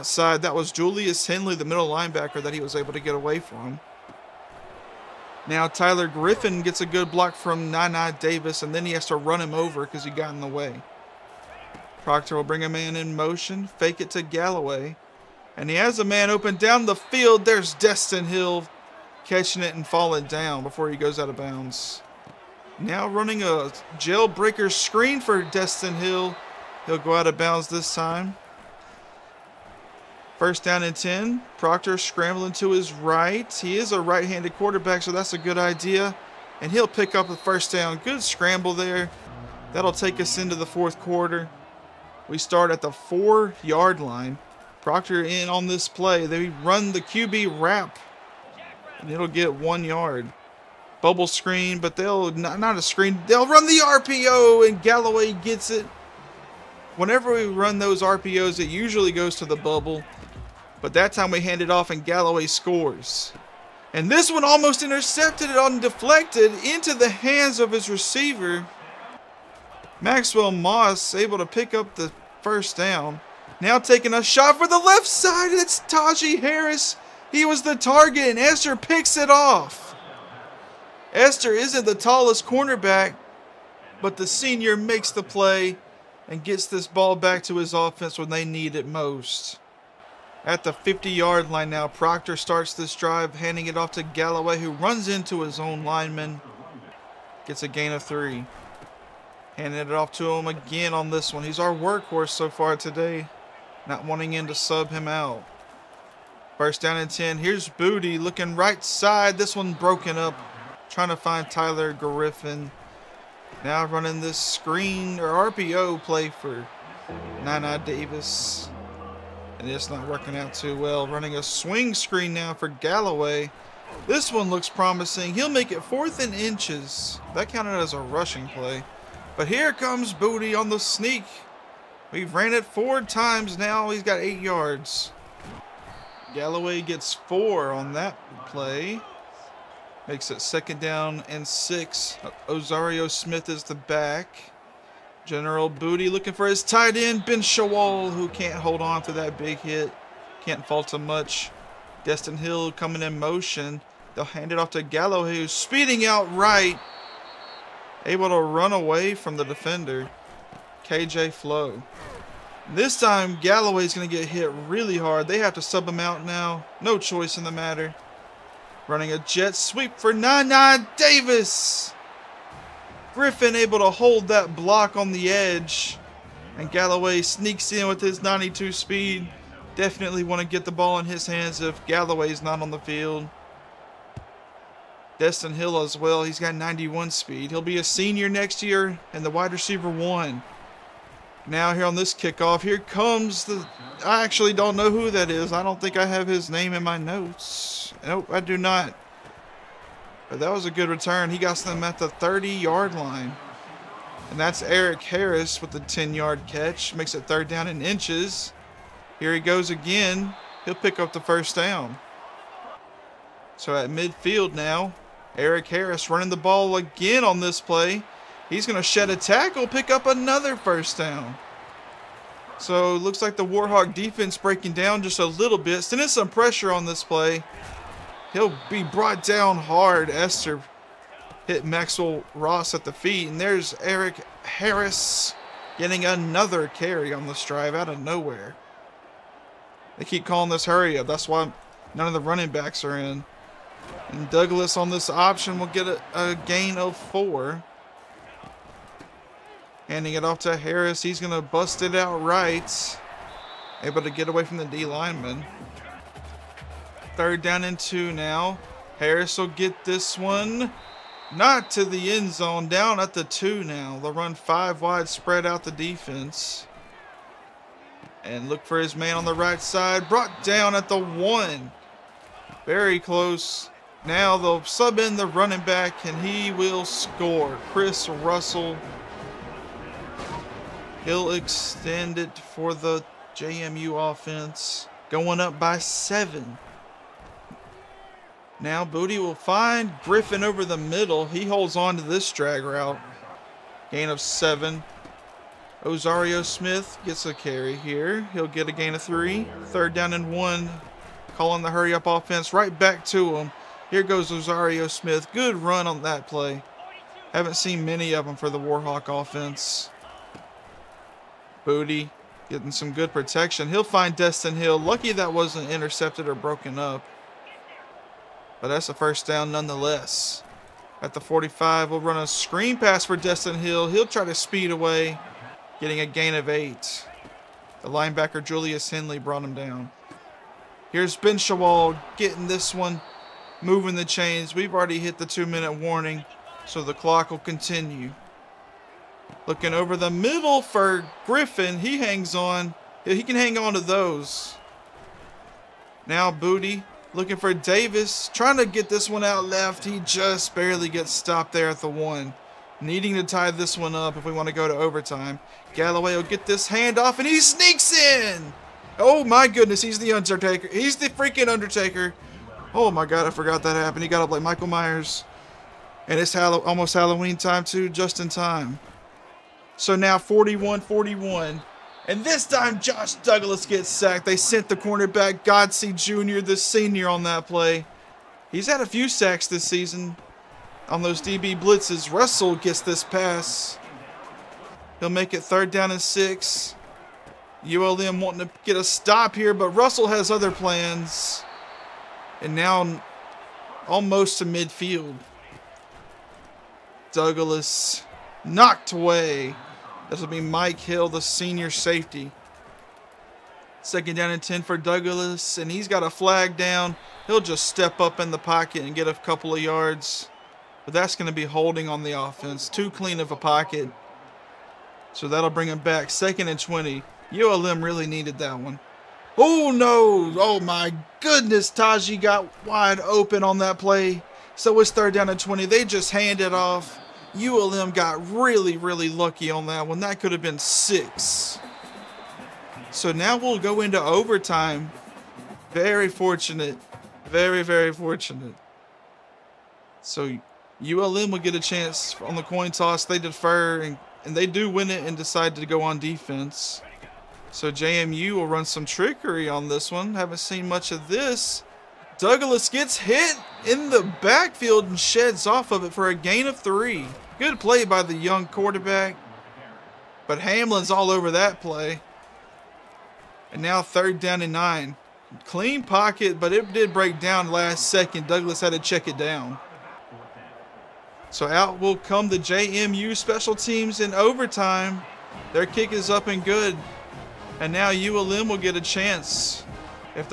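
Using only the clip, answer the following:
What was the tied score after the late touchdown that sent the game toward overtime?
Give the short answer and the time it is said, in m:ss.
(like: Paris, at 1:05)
41-41, at 6:10.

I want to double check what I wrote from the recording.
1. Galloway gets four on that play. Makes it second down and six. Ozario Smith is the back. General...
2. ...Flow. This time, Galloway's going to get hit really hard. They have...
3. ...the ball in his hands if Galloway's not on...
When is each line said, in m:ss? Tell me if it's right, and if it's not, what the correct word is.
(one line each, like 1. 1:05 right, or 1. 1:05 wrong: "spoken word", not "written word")
1. 2:16 right
2. 2:41 right
3. 3:00 right.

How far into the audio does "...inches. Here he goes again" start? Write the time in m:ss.
3:27.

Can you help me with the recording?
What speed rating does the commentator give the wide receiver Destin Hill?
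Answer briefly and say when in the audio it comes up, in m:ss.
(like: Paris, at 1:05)
91, at 3:06.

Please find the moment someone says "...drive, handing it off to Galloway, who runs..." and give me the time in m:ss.
1:32.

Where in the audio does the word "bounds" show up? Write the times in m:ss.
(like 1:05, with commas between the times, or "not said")
0:21, 0:27.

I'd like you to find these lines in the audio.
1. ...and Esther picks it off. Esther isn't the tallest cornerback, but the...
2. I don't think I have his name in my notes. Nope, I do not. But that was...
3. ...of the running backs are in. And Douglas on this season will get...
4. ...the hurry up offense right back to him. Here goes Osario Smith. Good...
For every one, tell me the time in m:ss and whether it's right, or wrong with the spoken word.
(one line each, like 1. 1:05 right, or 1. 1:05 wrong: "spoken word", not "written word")
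1. 1:18 right
2. 3:15 right
3. 4:02 wrong: "option", not "season"
4. 5:01 right.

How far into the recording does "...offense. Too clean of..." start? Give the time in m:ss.
6:52.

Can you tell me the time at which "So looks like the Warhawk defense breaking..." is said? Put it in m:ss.
3:42.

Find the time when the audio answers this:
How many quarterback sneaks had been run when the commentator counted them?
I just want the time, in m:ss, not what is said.
2:12.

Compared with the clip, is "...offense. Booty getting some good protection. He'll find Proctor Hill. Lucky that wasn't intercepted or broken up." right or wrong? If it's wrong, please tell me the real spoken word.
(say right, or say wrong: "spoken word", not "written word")
wrong: "Destin", not "Proctor".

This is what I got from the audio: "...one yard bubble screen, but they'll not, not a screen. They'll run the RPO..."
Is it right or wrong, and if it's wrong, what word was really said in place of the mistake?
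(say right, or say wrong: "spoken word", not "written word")
right.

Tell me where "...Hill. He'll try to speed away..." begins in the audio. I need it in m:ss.
5:23.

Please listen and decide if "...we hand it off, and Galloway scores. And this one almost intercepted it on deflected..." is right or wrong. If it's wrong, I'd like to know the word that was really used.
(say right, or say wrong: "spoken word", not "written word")
right.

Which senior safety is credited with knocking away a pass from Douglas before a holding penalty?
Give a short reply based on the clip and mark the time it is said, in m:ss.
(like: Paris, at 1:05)
Mike Hill, at 6:40.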